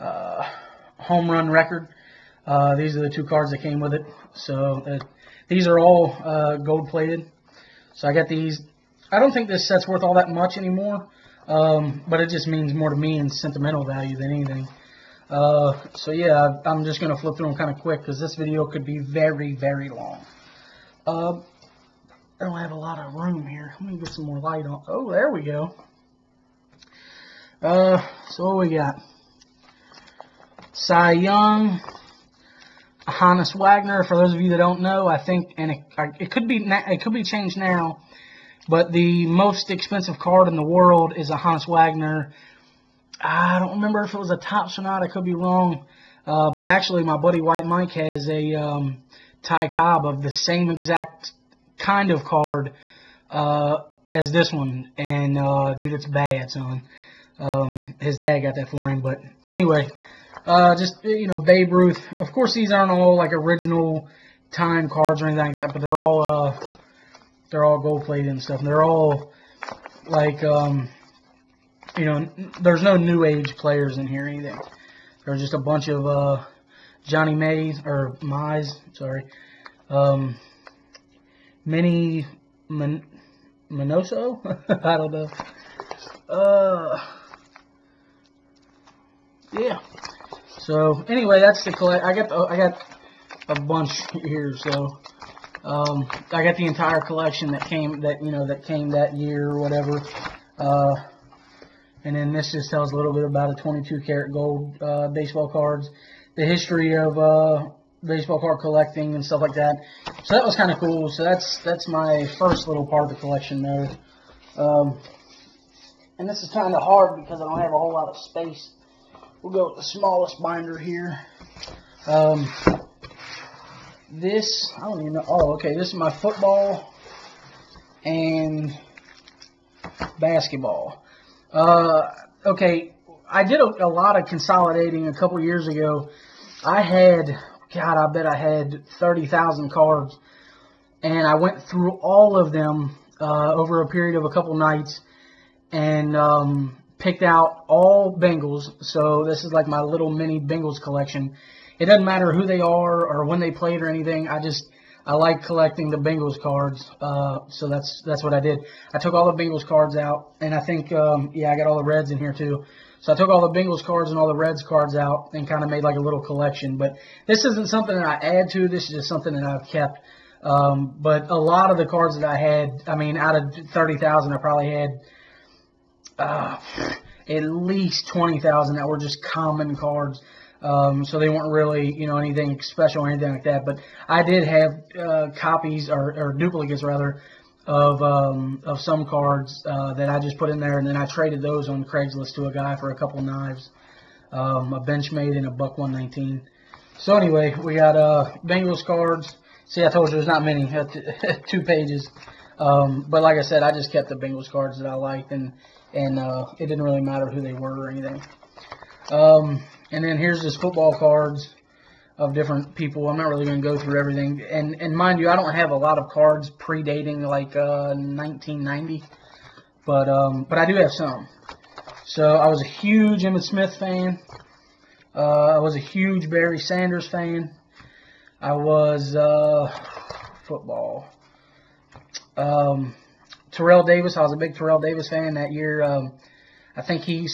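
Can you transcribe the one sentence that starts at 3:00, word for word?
Um, so they weren't really, you know, anything special or anything like that.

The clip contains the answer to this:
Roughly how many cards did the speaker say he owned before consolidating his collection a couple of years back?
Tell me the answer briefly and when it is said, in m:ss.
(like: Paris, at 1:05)
30,000, at 2:18.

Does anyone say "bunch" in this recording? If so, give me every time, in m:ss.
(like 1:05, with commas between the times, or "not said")
1:15, 1:33.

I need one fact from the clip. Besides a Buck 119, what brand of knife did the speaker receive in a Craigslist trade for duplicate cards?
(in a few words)
Benchmade.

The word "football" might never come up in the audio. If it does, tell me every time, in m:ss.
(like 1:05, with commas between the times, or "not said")
2:06, 3:30, 3:50.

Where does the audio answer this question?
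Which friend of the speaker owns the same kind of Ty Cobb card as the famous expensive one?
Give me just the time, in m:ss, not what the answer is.
0:47.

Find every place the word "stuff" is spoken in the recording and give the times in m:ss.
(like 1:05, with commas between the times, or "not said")
1:08, 1:49.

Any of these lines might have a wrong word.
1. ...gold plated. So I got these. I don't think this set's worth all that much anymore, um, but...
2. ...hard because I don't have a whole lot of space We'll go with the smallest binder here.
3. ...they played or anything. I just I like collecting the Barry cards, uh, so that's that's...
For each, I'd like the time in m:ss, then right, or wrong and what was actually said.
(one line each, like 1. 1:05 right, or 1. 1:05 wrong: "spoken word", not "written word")
1. 0:06 right
2. 1:56 right
3. 2:33 wrong: "Bengals", not "Barry".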